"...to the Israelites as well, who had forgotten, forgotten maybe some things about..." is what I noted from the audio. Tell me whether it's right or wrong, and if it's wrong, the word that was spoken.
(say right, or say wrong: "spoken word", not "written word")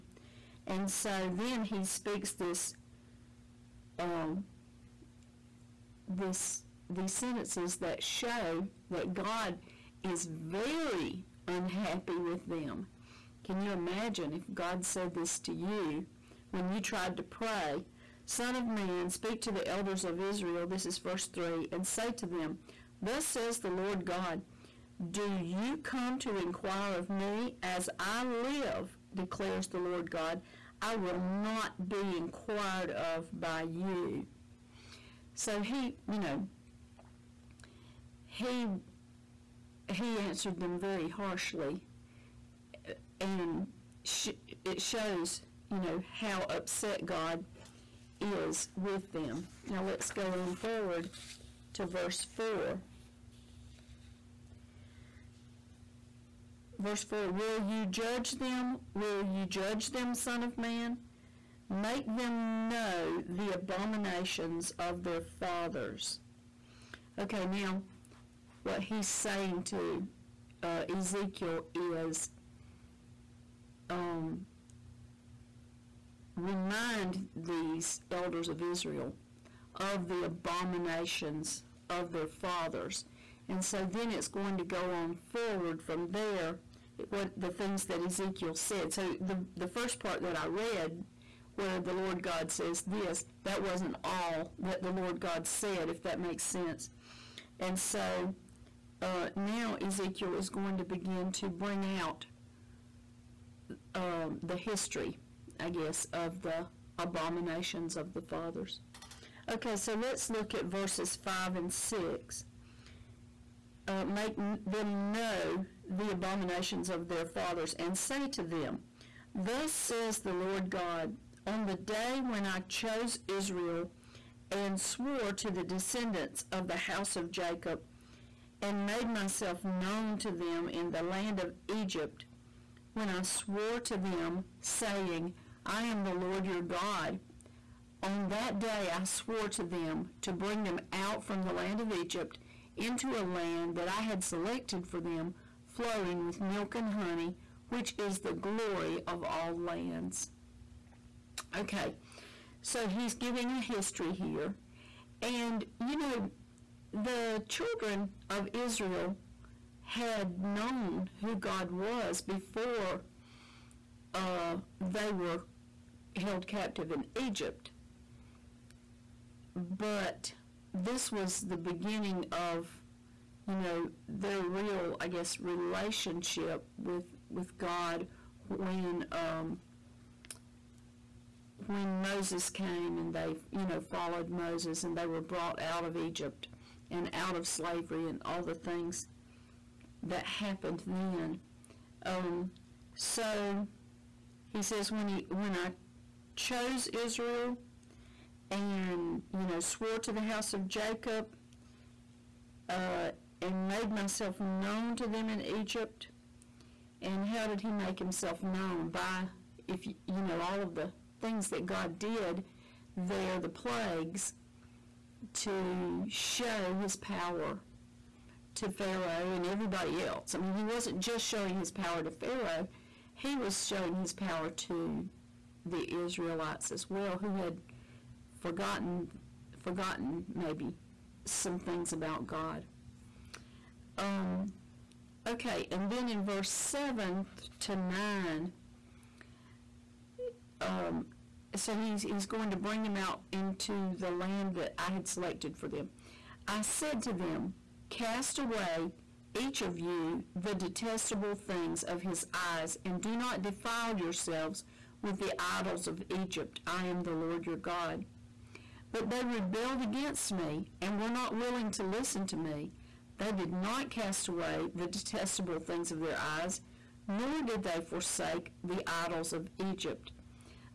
right.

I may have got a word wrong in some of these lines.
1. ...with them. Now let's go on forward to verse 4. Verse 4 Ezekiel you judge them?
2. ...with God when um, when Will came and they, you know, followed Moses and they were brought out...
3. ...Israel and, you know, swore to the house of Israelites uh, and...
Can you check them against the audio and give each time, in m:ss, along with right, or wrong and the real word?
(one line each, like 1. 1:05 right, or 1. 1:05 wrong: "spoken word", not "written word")
1. 0:48 wrong: "Will", not "Ezekiel"
2. 2:57 wrong: "Moses", not "Will"
3. 3:16 wrong: "Jacob", not "Israelites".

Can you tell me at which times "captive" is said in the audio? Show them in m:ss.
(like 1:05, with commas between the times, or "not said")
2:46.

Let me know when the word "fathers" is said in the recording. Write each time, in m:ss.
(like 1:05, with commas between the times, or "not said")
1:05, 1:22, 1:48, 1:57.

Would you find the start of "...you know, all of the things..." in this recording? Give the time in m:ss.
3:30.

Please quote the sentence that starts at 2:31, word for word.
Okay, so he's giving a history here.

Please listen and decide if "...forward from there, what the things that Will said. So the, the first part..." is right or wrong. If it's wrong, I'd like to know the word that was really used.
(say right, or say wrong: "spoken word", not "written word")
wrong: "Ezekiel", not "Will".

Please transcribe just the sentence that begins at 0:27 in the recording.
As I live, declares the Lord God, I will not be inquired of by you.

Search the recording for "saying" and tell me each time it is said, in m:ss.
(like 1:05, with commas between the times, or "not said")
1:09, 2:14.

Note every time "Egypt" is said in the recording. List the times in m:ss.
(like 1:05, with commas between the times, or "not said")
2:11, 2:21, 2:47, 3:05, 3:25, 4:16, 4:29.